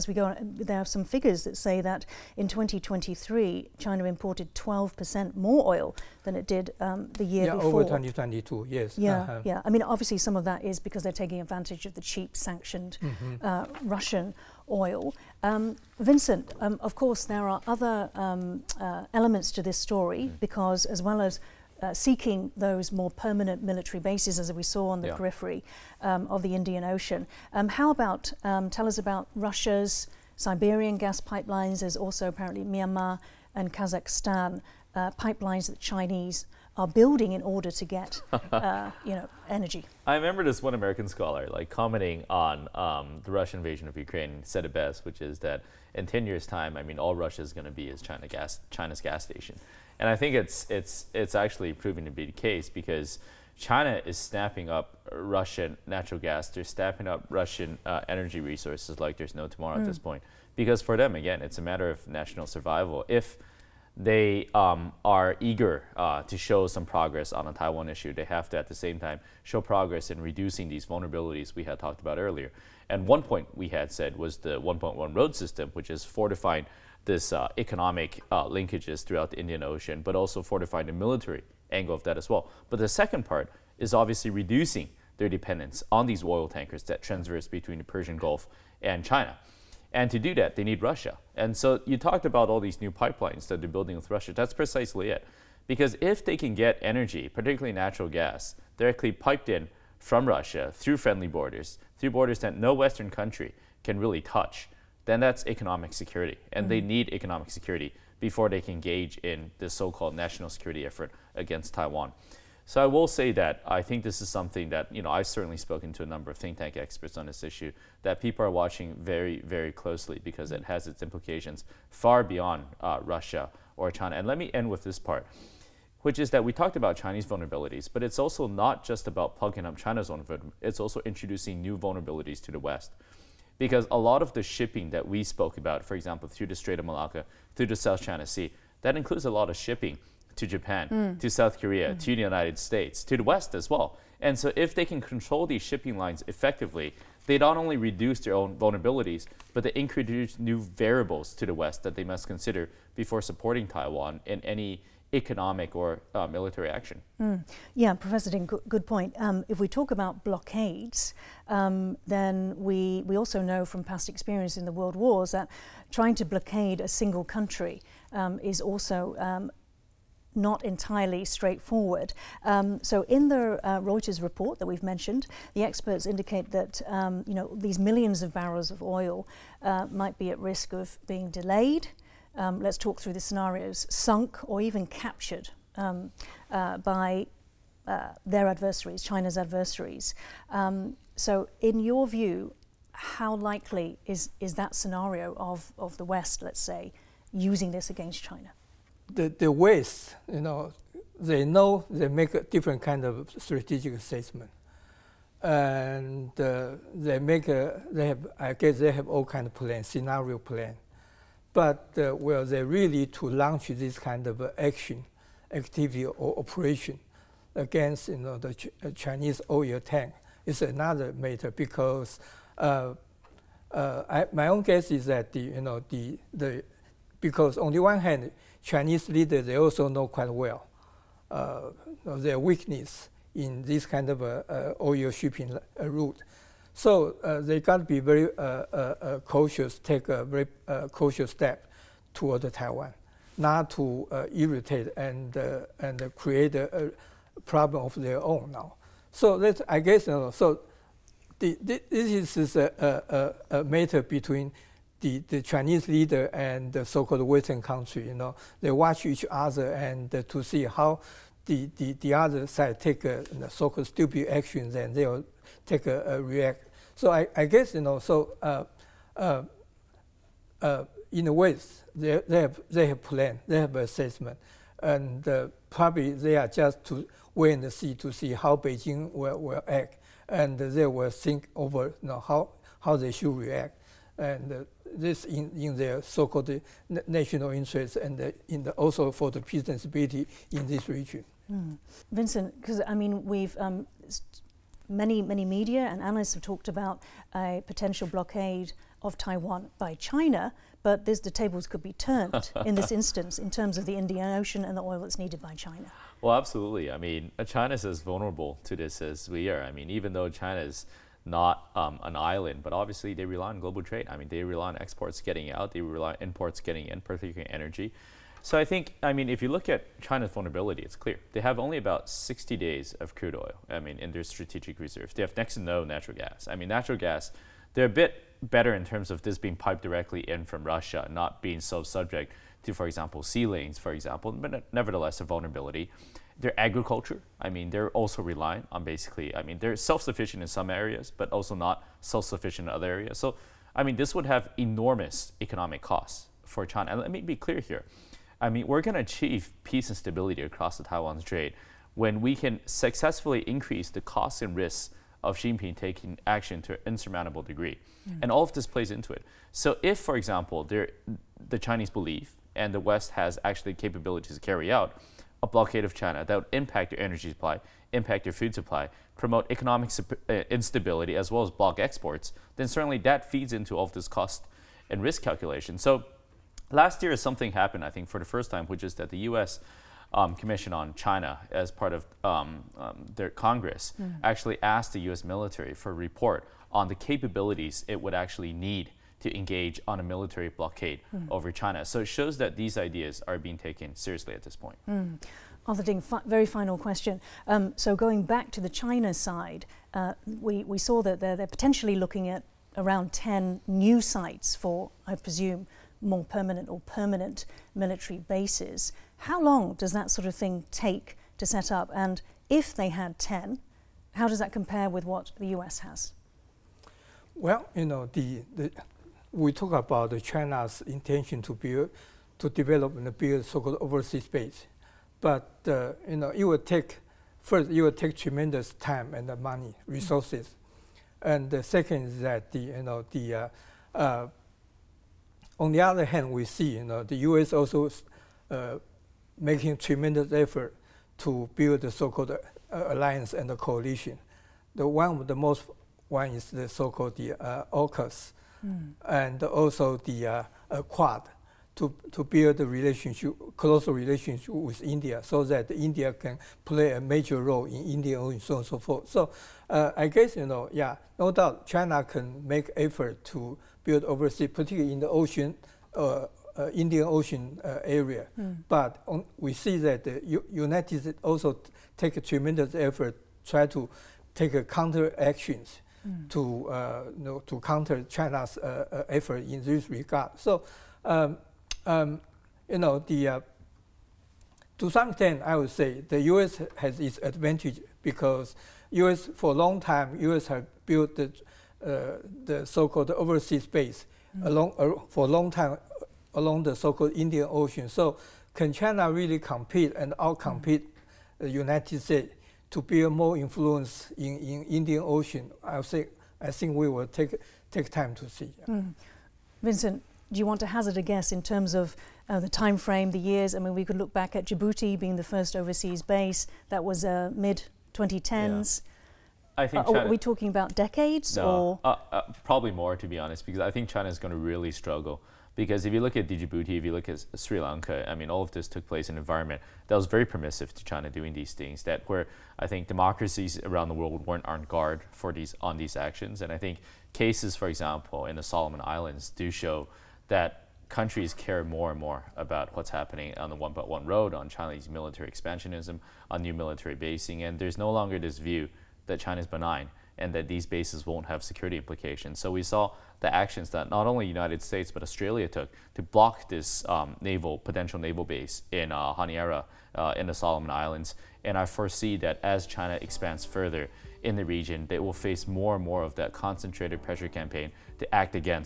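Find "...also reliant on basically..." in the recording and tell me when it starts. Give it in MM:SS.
05:37.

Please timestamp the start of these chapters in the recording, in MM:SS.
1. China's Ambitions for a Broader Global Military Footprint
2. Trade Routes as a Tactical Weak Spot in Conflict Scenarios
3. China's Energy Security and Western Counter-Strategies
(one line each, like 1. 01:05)
1. 06:43
2. 00:19
3. 02:47.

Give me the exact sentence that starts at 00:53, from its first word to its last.
China is snapping up Russian natural gas.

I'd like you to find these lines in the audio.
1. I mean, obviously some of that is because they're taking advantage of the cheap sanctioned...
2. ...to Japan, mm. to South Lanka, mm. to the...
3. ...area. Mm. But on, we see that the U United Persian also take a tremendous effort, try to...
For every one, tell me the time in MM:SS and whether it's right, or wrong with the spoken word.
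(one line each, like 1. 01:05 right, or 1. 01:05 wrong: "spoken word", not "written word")
1. 00:09 right
2. 02:20 wrong: "Korea", not "Lanka"
3. 07:47 wrong: "States", not "Persian".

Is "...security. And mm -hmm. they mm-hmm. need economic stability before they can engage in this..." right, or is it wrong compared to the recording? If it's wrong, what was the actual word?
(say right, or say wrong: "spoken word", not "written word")
wrong: "security", not "stability".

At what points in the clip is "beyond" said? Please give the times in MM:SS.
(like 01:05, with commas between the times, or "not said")
02:02.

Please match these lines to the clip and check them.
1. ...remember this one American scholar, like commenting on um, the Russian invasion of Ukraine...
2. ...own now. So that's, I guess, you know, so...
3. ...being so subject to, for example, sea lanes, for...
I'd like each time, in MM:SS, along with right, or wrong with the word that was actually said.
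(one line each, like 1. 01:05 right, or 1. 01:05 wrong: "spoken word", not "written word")
1. 00:40 right
2. 04:08 right
3. 05:31 right.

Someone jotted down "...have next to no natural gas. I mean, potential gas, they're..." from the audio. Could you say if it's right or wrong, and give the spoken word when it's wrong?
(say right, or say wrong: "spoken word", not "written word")
wrong: "natural", not "potential".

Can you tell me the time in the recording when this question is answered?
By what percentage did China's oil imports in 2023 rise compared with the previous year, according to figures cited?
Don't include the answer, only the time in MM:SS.
00:04.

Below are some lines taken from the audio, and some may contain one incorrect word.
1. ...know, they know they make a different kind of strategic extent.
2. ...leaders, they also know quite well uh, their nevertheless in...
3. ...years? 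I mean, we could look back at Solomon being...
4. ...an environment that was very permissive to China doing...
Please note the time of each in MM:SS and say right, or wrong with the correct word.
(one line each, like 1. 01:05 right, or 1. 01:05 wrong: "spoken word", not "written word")
1. 03:20 wrong: "assessment", not "extent"
2. 03:49 wrong: "weakness", not "nevertheless"
3. 08:33 wrong: "Djibouti", not "Solomon"
4. 08:49 right.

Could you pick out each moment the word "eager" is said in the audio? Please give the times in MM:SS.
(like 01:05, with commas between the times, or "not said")
01:05.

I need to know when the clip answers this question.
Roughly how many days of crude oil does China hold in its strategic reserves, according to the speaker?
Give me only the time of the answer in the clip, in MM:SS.
05:22.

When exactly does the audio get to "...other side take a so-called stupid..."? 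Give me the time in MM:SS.
04:22.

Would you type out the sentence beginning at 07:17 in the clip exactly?
also uh, making tremendous effort to build the so-called uh, alliance and the coalition.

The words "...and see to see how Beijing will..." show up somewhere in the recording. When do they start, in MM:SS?
04:37.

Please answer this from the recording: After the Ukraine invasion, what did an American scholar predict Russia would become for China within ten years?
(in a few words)
China's gas station.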